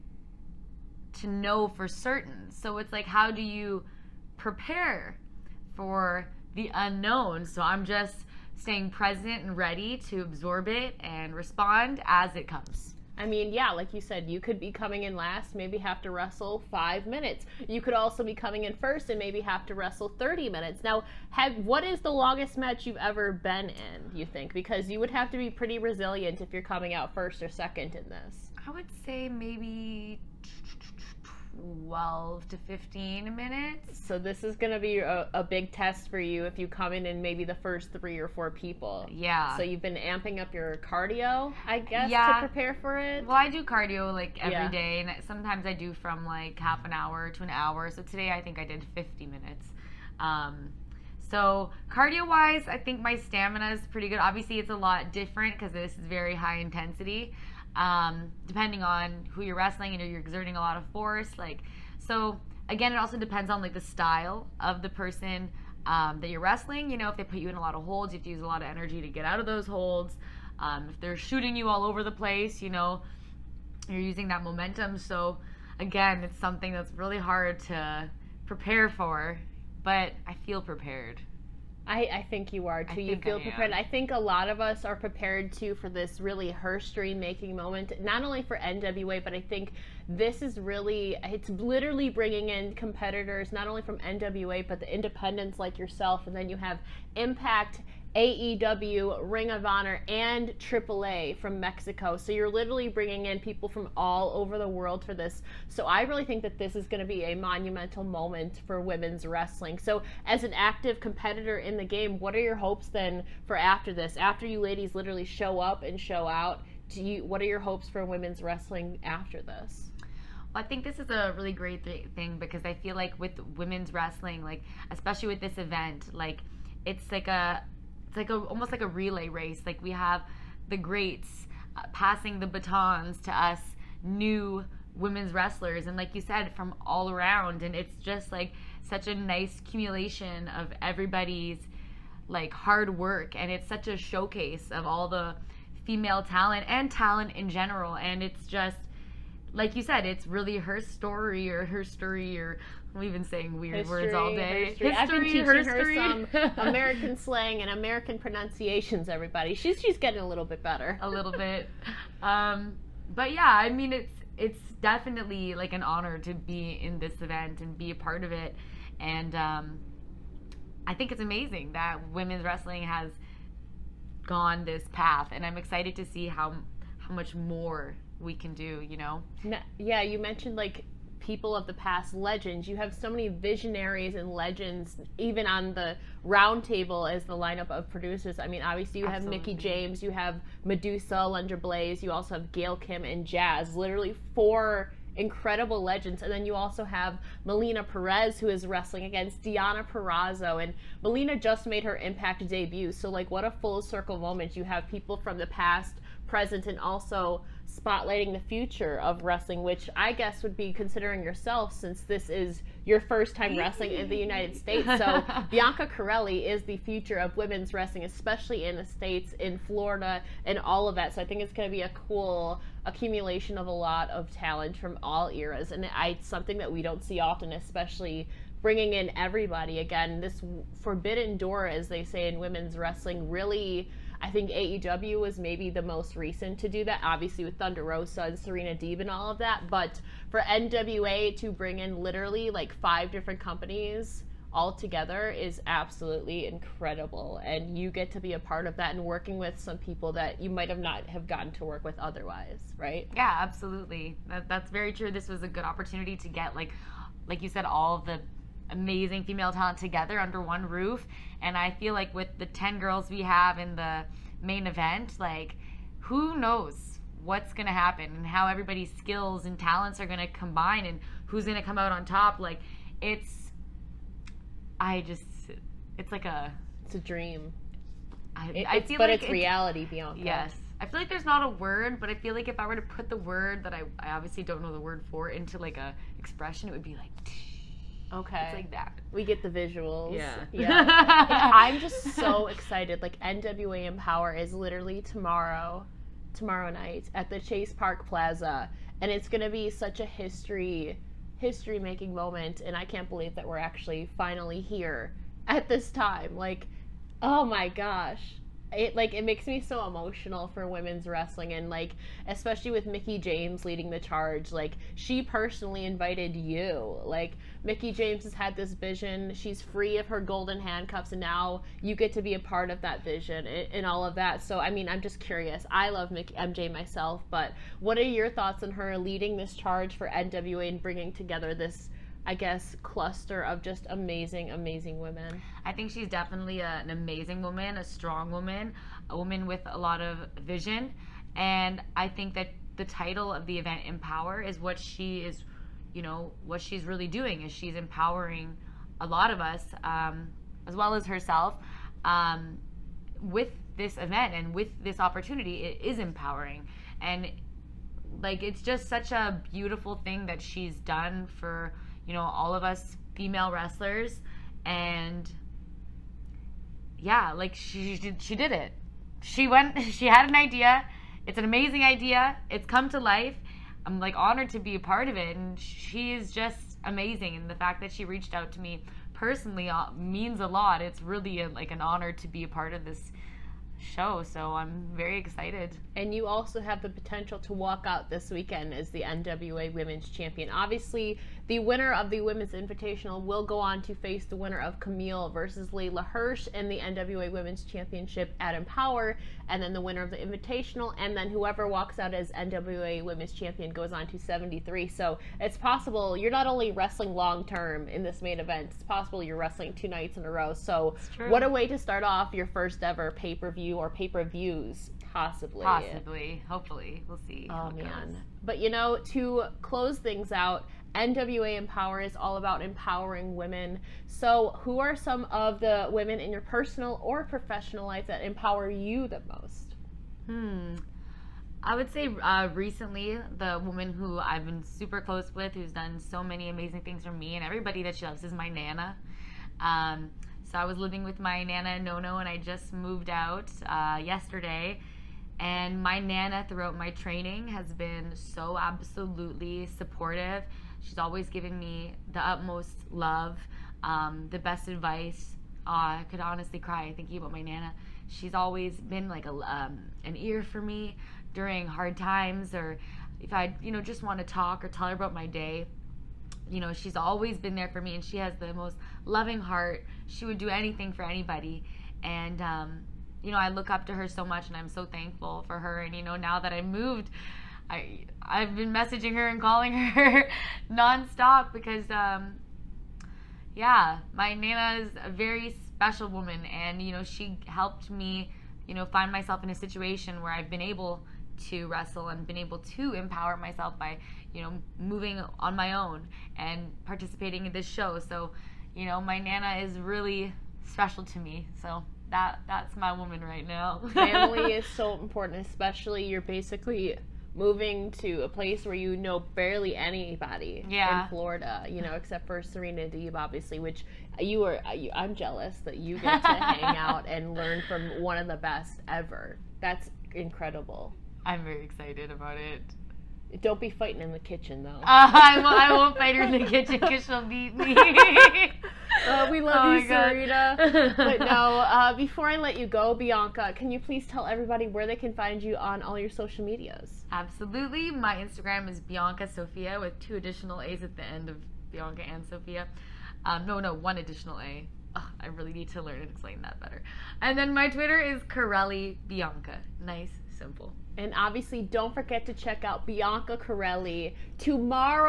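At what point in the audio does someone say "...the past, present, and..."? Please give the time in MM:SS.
03:25.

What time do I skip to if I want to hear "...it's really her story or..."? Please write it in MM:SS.
02:30.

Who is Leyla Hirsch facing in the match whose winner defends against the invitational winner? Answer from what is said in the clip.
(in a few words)
Kamille.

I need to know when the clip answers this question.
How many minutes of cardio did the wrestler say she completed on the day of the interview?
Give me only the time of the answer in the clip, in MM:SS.
00:48.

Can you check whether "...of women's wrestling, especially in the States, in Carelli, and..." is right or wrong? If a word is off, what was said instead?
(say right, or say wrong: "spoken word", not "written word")
wrong: "Florida", not "Carelli".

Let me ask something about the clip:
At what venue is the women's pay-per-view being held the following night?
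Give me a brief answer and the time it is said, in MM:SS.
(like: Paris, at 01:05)
Chase Park Plaza, at 04:57.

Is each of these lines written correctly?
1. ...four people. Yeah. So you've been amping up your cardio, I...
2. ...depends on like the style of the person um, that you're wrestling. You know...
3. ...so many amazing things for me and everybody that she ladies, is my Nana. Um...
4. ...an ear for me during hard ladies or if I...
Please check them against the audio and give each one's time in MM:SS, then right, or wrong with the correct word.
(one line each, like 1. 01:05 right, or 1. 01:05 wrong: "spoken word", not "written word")
1. 00:38 right
2. 01:03 right
3. 07:15 wrong: "loves", not "ladies"
4. 07:40 wrong: "times", not "ladies".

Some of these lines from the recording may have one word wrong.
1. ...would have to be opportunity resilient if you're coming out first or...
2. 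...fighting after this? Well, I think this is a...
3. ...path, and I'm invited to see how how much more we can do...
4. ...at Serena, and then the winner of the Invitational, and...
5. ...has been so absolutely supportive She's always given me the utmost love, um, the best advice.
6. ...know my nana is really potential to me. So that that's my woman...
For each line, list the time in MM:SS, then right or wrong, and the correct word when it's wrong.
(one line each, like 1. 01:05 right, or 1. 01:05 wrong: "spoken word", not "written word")
1. 00:24 wrong: "pretty", not "opportunity"
2. 01:58 wrong: "wrestling", not "fighting"
3. 02:54 wrong: "excited", not "invited"
4. 06:38 wrong: "Empower", not "Serena"
5. 07:27 right
6. 08:18 wrong: "special", not "potential".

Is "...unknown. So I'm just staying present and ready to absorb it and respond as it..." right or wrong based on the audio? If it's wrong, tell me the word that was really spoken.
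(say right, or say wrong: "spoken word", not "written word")
right.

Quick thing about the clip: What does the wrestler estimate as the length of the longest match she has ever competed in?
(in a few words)
12 to 15 minutes.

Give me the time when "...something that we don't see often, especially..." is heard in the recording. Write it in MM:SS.
03:46.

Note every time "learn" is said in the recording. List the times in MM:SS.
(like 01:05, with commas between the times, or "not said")
08:37, 09:05.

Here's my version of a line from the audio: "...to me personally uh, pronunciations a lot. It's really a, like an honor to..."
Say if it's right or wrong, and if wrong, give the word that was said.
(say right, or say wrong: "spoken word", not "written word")
wrong: "means", not "pronunciations".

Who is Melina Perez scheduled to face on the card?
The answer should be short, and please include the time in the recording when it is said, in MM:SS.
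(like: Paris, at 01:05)
Deonna Purrazzo, at 03:19.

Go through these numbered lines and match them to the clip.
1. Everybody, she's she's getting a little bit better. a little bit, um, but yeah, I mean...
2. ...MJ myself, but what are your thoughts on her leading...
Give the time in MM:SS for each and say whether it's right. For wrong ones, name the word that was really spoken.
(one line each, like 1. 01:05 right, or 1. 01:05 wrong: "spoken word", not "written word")
1. 02:39 right
2. 05:26 right.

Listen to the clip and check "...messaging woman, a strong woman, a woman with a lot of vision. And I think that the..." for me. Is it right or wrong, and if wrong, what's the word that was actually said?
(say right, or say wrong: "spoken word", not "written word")
wrong: "amazing", not "messaging".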